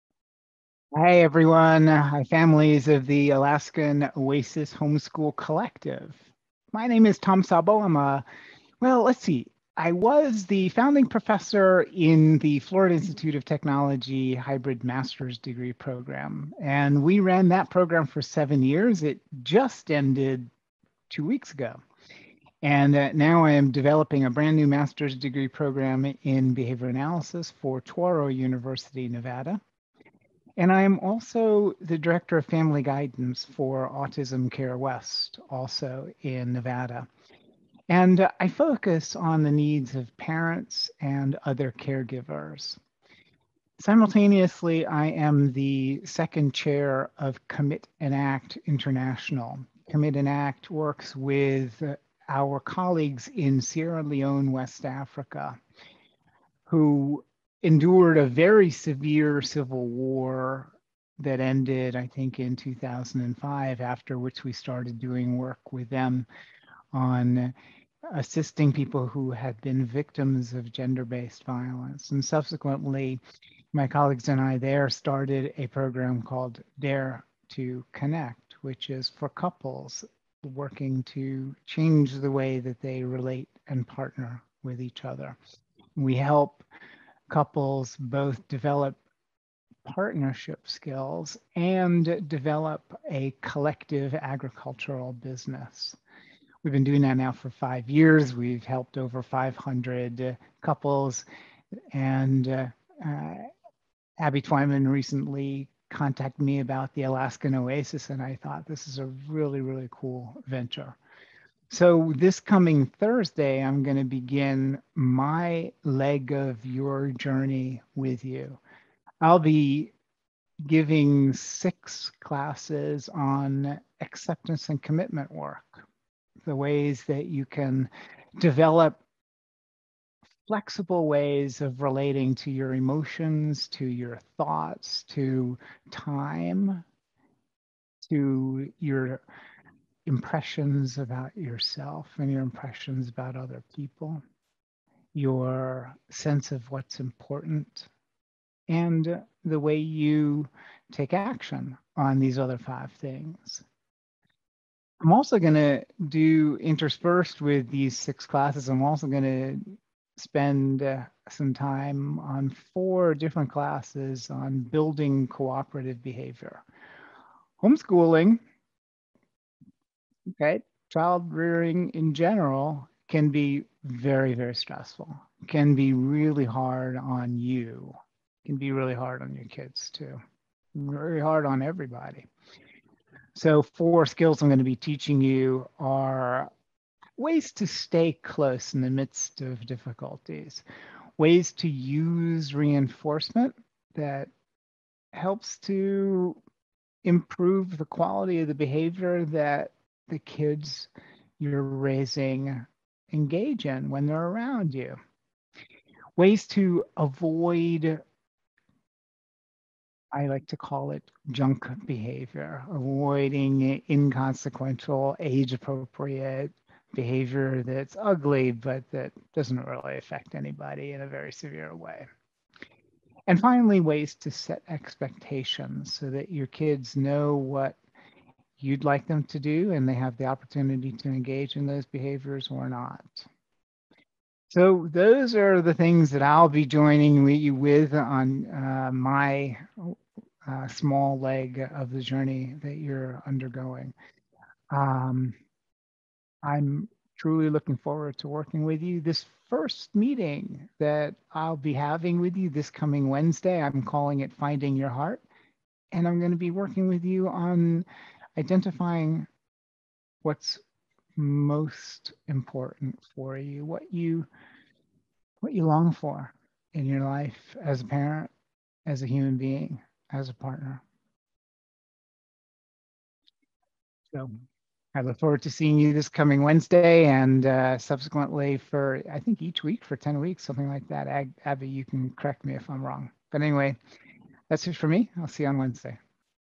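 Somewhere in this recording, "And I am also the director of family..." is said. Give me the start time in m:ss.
0:30.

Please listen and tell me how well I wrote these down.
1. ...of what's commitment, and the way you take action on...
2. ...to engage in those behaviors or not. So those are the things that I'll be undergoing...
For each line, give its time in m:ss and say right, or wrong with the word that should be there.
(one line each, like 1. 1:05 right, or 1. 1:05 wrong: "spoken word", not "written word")
1. 2:26 wrong: "important", not "commitment"
2. 3:50 wrong: "joining", not "undergoing".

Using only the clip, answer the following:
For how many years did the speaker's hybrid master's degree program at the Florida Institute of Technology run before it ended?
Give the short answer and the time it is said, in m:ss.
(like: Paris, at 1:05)
7, at 0:18.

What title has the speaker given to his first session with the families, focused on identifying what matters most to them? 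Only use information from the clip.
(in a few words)
Finding Your Heart.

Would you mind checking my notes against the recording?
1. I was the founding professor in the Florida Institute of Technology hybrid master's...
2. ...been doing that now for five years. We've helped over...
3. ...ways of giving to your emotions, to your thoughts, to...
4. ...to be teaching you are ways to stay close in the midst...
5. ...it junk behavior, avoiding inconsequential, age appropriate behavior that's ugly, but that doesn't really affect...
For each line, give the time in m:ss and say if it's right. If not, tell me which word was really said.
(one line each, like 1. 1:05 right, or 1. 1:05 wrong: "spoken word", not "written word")
1. 0:09 right
2. 1:36 right
3. 2:11 wrong: "relating", not "giving"
4. 3:04 right
5. 3:30 right.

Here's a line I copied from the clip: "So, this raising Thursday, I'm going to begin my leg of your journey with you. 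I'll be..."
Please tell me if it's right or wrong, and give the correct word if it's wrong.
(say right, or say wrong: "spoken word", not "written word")
wrong: "coming", not "raising".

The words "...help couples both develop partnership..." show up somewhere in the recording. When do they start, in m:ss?
1:26.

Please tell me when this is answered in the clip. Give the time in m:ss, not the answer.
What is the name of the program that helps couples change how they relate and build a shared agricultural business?
1:16.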